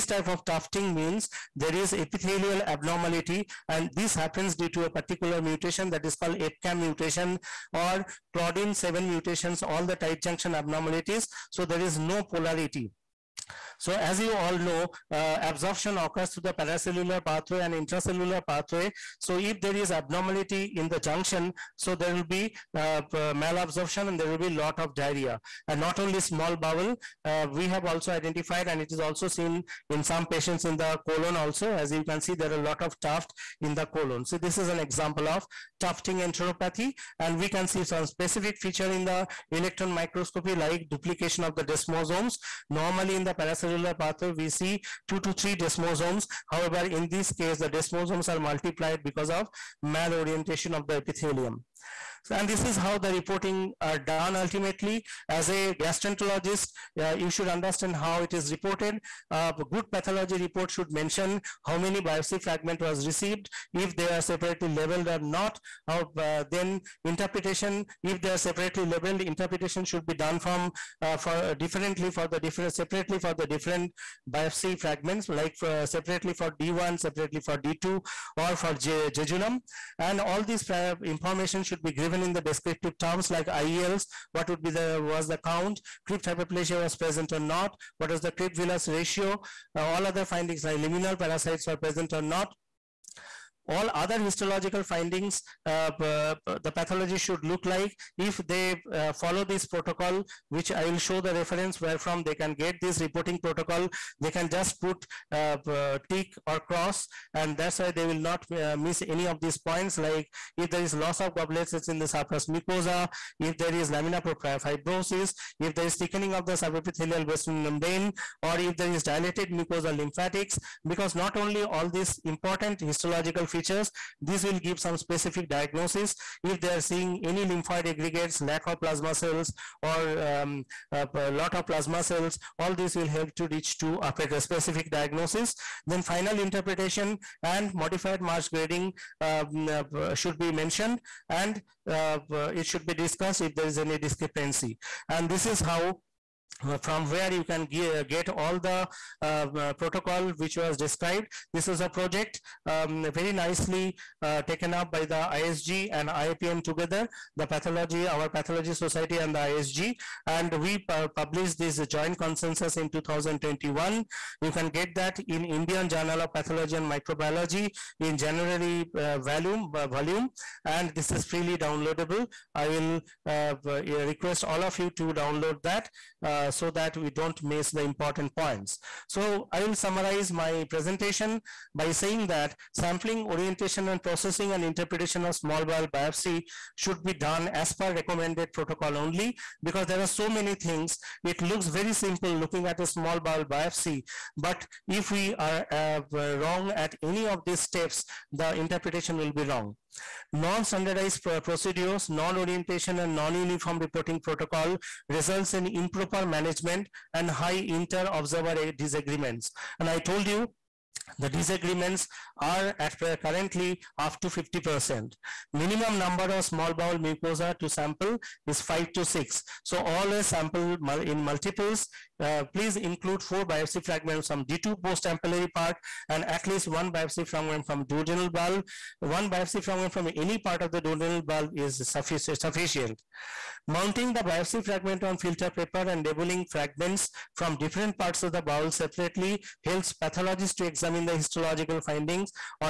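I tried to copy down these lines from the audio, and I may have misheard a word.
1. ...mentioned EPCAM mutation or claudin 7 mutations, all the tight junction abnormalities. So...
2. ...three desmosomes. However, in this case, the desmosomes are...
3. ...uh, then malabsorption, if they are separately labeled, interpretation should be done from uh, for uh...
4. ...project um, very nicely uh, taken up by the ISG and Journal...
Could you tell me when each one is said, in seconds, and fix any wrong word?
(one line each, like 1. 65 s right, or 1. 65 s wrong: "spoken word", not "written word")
1. 6 s wrong: "called", not "mentioned"
2. 45 s right
3. 66 s wrong: "interpretation", not "malabsorption"
4. 151 s wrong: "IAPM", not "Journal".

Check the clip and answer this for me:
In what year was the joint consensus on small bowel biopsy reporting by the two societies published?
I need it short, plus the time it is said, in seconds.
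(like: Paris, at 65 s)
2021, at 162 s.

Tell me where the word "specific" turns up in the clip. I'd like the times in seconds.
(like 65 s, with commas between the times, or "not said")
38 s, 125 s, 134 s.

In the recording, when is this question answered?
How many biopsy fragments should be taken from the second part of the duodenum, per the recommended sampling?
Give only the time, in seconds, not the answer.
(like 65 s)
223 s.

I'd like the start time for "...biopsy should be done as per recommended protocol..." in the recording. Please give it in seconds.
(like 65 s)
185 s.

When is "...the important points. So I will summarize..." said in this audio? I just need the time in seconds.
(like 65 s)
177 s.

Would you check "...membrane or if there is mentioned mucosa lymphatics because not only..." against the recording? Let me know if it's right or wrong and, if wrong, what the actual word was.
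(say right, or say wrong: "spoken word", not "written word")
wrong: "dilated", not "mentioned".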